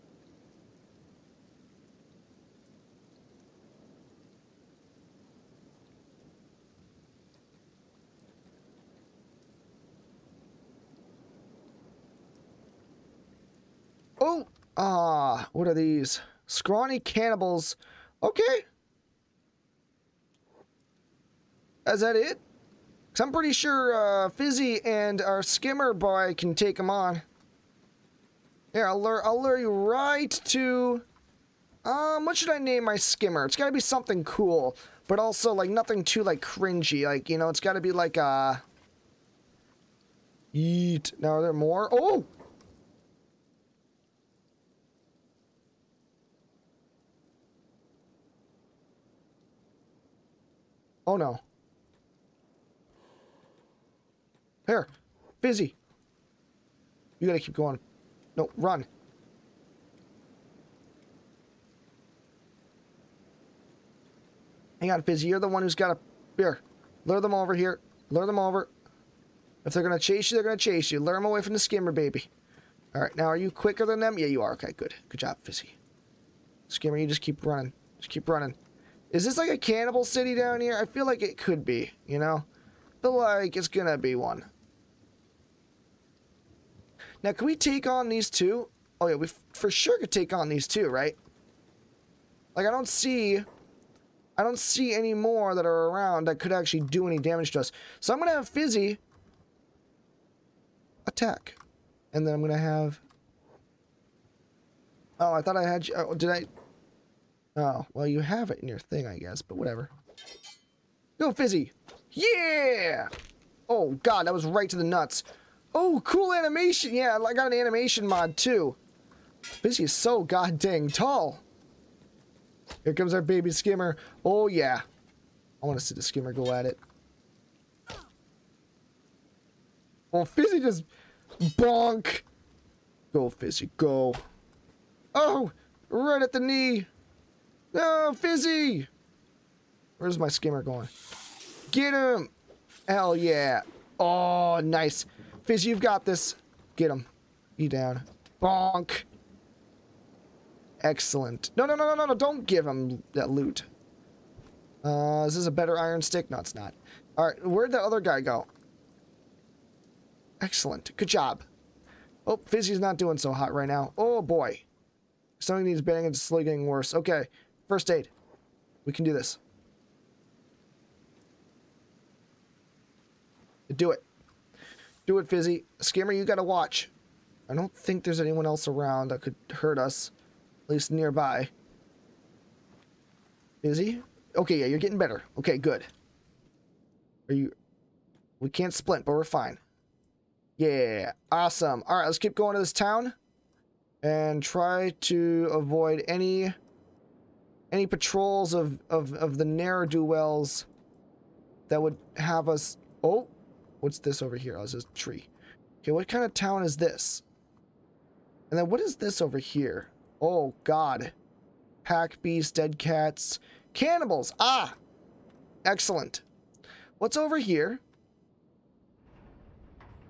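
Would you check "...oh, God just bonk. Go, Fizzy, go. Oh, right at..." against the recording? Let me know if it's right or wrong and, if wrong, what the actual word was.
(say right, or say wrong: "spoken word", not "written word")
wrong: "Fizzy", not "God".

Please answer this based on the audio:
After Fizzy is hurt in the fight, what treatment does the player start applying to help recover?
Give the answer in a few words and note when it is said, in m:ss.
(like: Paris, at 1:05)
First aid, at 2:47.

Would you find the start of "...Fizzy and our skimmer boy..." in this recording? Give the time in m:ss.
0:24.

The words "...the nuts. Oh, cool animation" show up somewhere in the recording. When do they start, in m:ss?
1:54.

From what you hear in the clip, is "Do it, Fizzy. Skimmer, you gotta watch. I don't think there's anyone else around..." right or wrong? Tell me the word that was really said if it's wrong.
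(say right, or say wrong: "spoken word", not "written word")
right.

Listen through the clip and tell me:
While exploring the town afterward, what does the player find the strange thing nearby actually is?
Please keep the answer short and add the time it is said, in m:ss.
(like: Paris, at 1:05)
A tree, at 3:24.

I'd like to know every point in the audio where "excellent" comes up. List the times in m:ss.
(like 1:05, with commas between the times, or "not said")
2:30, 2:40, 3:35.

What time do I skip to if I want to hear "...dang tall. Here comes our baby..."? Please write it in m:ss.
2:00.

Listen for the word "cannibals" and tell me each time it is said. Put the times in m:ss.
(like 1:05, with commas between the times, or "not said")
0:16, 1:19, 3:33.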